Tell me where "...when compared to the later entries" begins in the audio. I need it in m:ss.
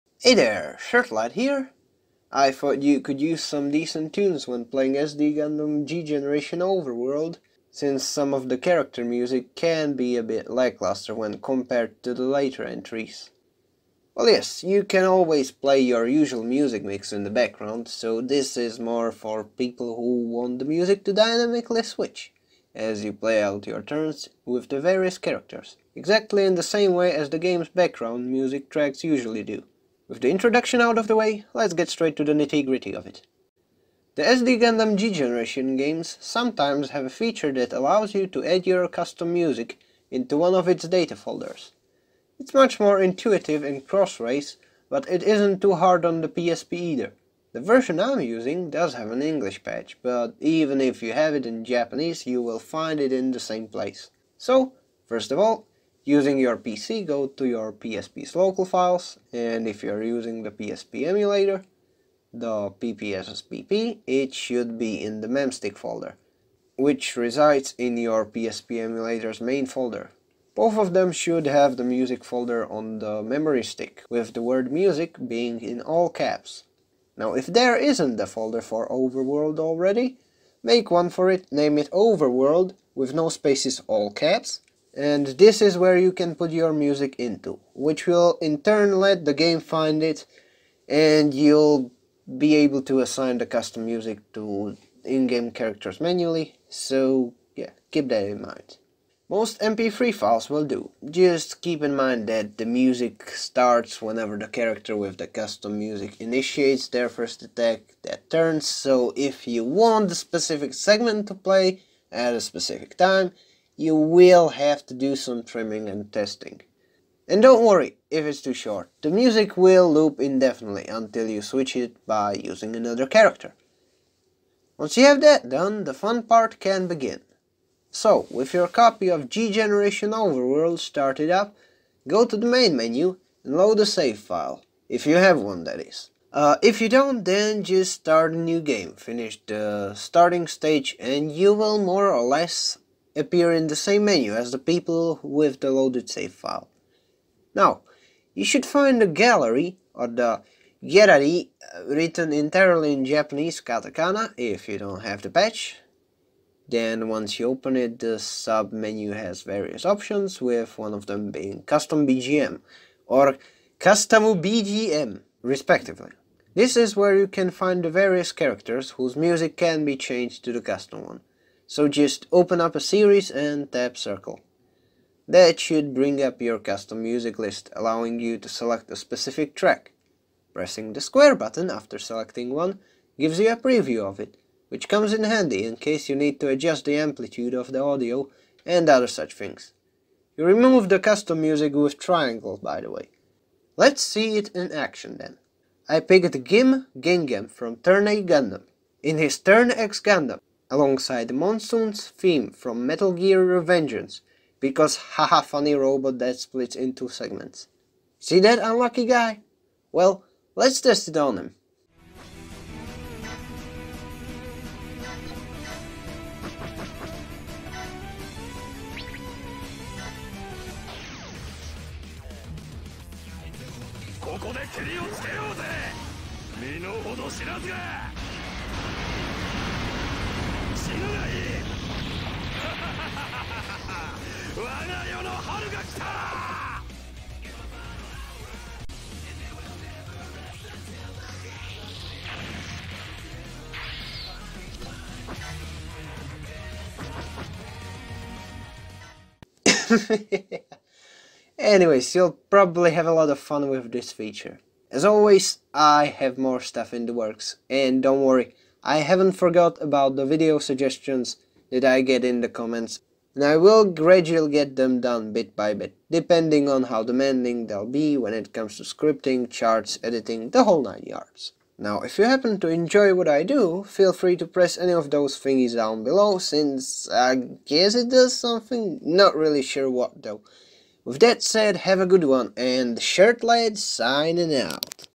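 0:11.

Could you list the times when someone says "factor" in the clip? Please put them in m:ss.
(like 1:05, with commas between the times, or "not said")
not said.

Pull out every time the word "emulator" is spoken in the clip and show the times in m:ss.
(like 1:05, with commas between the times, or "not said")
1:01, 1:08.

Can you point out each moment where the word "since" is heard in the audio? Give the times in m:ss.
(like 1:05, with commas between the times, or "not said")
0:07, 4:36.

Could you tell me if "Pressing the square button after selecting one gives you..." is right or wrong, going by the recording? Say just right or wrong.
right.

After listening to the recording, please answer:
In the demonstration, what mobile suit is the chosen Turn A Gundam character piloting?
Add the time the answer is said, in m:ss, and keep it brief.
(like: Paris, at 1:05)
Turn X Gundam, at 3:19.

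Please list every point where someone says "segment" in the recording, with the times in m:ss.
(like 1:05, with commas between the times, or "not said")
1:50, 3:27.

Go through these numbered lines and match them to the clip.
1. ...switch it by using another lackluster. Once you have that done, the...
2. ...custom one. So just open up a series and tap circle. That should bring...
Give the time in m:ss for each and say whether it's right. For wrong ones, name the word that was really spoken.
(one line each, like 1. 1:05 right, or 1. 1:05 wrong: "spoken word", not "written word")
1. 2:01 wrong: "character", not "lackluster"
2. 2:50 right.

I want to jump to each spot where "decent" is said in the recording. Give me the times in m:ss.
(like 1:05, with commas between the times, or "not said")
0:03.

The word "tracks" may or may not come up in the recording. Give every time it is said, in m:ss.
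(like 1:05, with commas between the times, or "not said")
0:28, 2:59.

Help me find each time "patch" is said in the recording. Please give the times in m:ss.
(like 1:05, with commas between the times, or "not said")
0:49, 2:35.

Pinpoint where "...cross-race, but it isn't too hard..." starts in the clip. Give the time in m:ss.
0:44.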